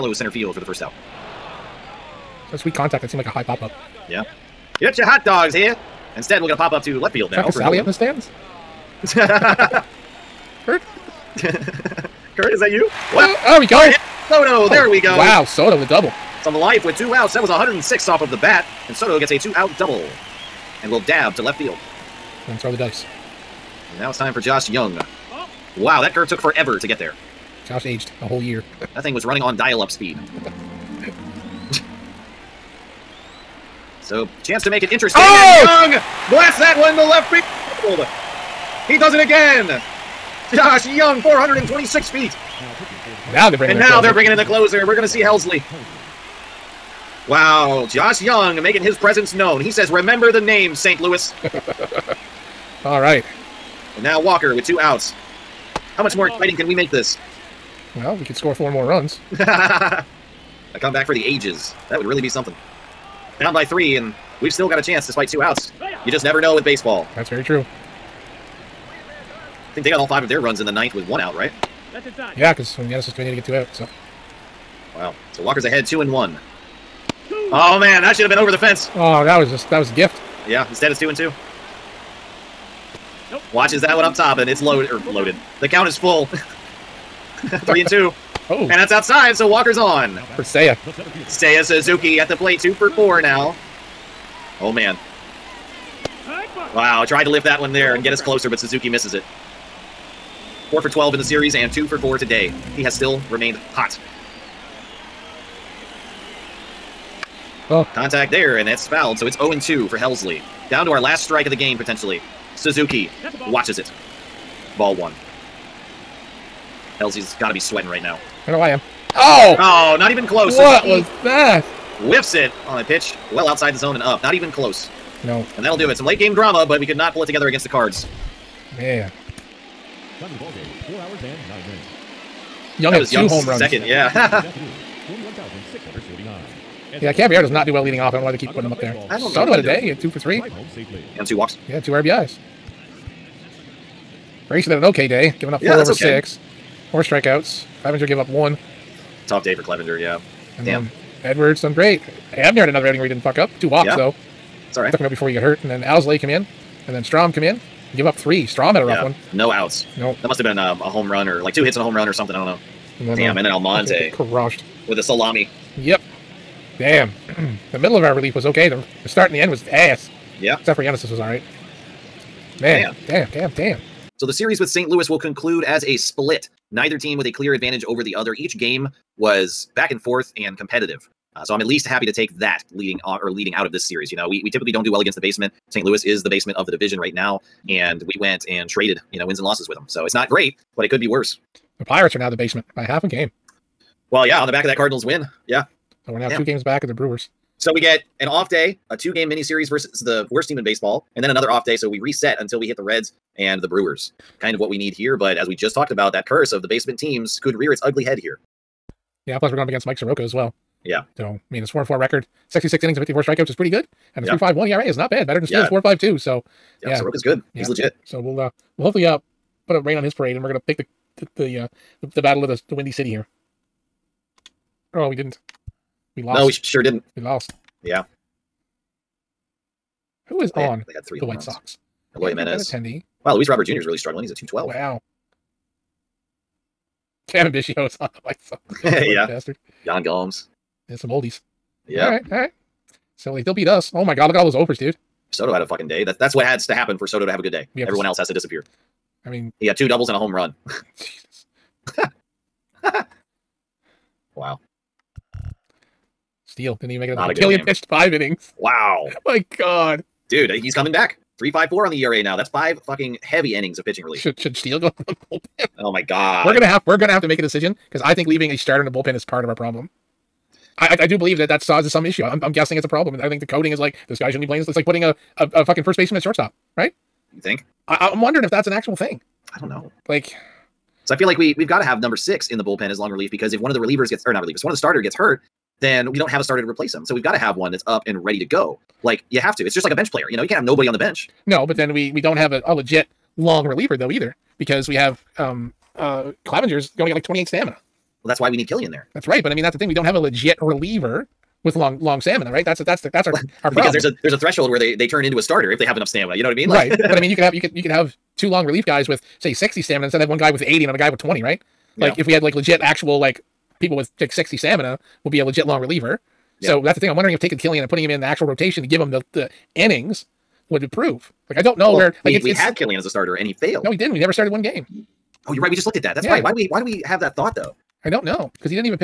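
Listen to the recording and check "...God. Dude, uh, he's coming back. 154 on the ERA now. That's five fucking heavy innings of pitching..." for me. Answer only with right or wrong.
wrong.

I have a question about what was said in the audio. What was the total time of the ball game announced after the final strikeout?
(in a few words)
4 hours and 9 minutes.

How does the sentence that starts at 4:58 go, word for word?
Well, that's why we need Kilian there.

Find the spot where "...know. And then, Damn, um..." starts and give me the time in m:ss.
2:42.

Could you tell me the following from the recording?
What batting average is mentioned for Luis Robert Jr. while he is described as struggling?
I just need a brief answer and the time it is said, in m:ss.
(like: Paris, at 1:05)
212, at 3:54.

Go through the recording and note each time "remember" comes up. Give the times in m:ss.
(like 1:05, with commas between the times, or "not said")
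0:49.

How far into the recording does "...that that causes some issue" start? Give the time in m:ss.
4:31.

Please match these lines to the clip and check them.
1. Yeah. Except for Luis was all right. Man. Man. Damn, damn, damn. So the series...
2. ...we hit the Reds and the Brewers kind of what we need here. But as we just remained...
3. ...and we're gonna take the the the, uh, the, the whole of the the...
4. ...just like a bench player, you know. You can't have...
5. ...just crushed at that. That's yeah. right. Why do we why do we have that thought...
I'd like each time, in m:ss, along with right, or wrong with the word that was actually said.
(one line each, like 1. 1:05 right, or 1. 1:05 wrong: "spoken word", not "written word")
1. 2:50 wrong: "Yanis", not "Luis"
2. 3:22 wrong: "talked", not "remained"
3. 3:40 wrong: "battle", not "whole"
4. 4:49 right
5. 5:25 wrong: "looked", not "crushed".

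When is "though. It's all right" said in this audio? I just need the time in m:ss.
2:33.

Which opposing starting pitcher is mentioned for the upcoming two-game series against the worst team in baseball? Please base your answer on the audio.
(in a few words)
Mike Soroka.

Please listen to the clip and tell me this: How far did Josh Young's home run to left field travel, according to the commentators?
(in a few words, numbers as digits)
426 feet.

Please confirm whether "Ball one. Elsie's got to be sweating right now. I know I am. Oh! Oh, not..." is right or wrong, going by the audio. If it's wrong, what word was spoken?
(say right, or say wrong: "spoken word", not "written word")
right.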